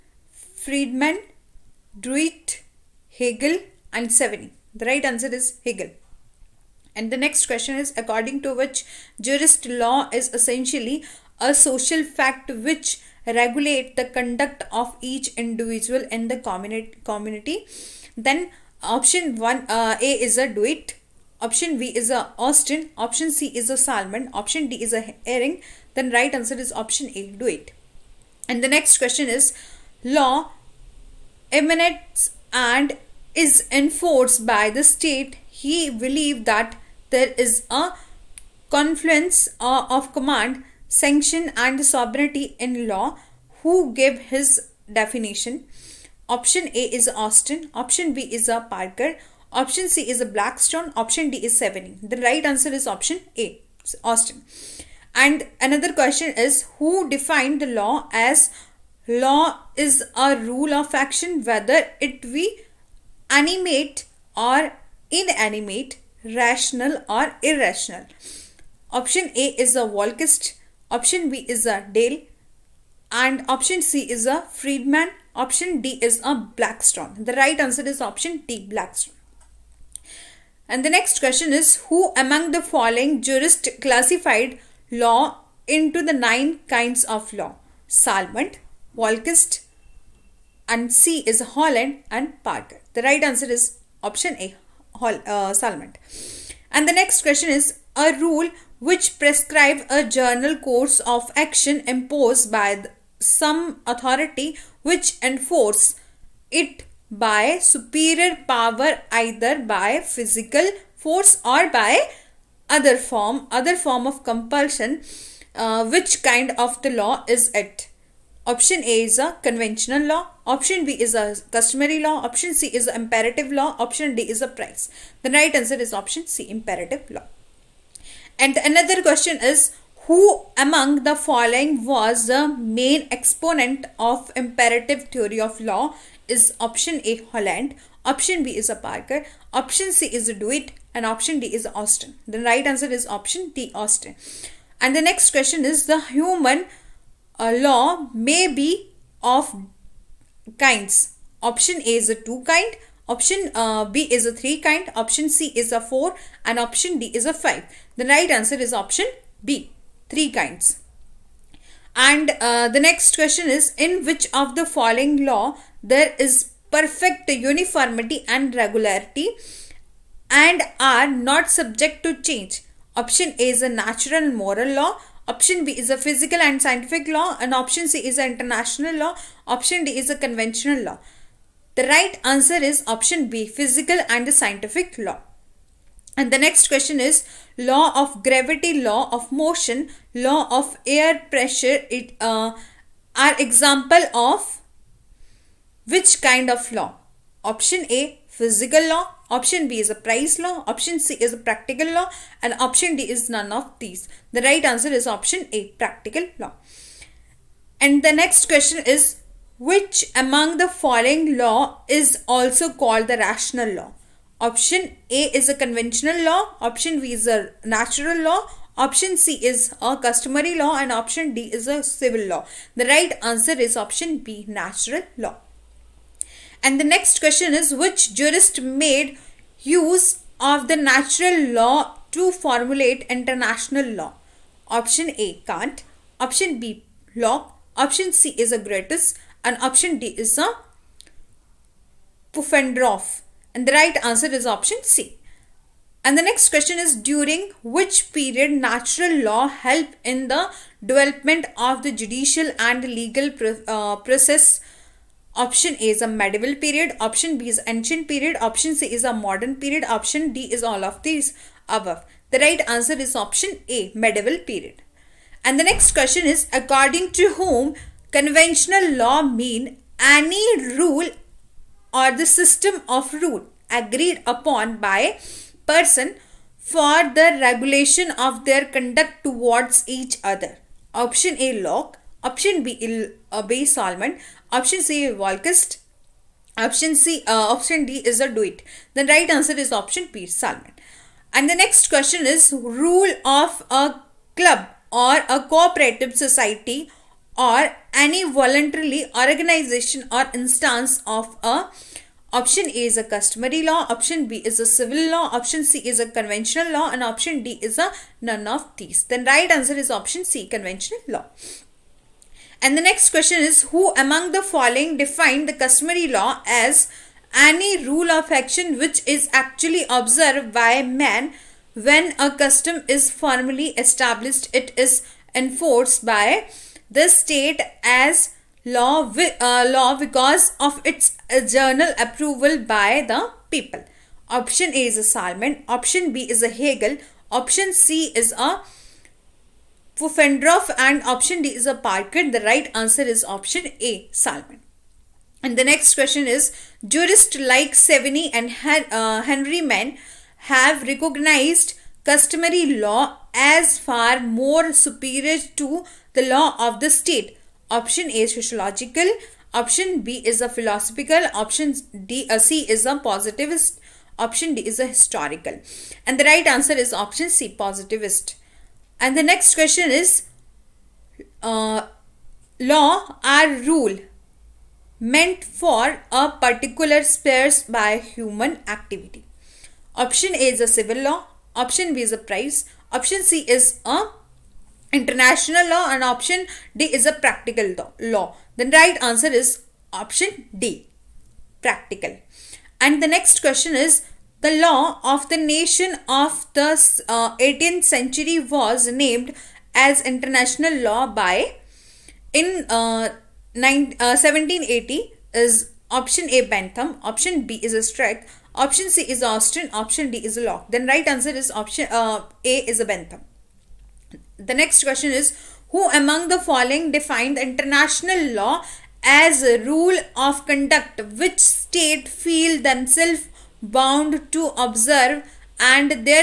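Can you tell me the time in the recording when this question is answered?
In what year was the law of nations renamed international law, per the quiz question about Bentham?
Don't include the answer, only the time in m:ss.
6:44.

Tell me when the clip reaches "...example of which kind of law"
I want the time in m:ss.
3:13.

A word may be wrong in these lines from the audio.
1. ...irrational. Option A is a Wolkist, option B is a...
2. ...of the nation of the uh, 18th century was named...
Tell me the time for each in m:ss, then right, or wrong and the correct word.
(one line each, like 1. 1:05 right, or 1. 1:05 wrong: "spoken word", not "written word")
1. 1:07 right
2. 6:35 right.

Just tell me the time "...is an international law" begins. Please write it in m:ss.
2:58.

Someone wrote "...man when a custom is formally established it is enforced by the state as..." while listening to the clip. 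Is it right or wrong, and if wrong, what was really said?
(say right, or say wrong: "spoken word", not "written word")
right.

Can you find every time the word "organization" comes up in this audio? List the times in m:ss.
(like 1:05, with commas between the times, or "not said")
4:59.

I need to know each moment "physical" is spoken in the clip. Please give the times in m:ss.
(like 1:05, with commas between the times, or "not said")
1:49, 2:55, 3:03, 3:18.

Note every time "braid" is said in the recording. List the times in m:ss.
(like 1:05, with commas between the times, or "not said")
not said.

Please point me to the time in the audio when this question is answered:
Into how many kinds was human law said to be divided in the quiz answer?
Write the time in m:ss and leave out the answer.
2:40.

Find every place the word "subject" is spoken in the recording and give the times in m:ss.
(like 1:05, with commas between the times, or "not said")
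2:51.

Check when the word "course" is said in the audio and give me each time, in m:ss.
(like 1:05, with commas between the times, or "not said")
1:40.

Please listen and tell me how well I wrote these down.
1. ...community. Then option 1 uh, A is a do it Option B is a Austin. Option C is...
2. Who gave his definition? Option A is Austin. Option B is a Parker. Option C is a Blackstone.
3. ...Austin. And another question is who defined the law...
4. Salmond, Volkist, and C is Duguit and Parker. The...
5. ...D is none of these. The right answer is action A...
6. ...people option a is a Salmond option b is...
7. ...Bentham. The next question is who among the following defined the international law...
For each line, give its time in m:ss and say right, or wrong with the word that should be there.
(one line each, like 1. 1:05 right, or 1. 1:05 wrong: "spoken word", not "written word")
1. 0:17 right
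2. 0:43 right
3. 0:54 right
4. 1:27 wrong: "Holland", not "Duguit"
5. 3:22 wrong: "option", not "action"
6. 5:33 right
7. 6:52 right.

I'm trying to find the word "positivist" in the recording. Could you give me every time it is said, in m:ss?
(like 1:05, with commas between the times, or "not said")
6:02, 6:07.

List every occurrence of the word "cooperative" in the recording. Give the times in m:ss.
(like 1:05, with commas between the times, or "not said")
4:55.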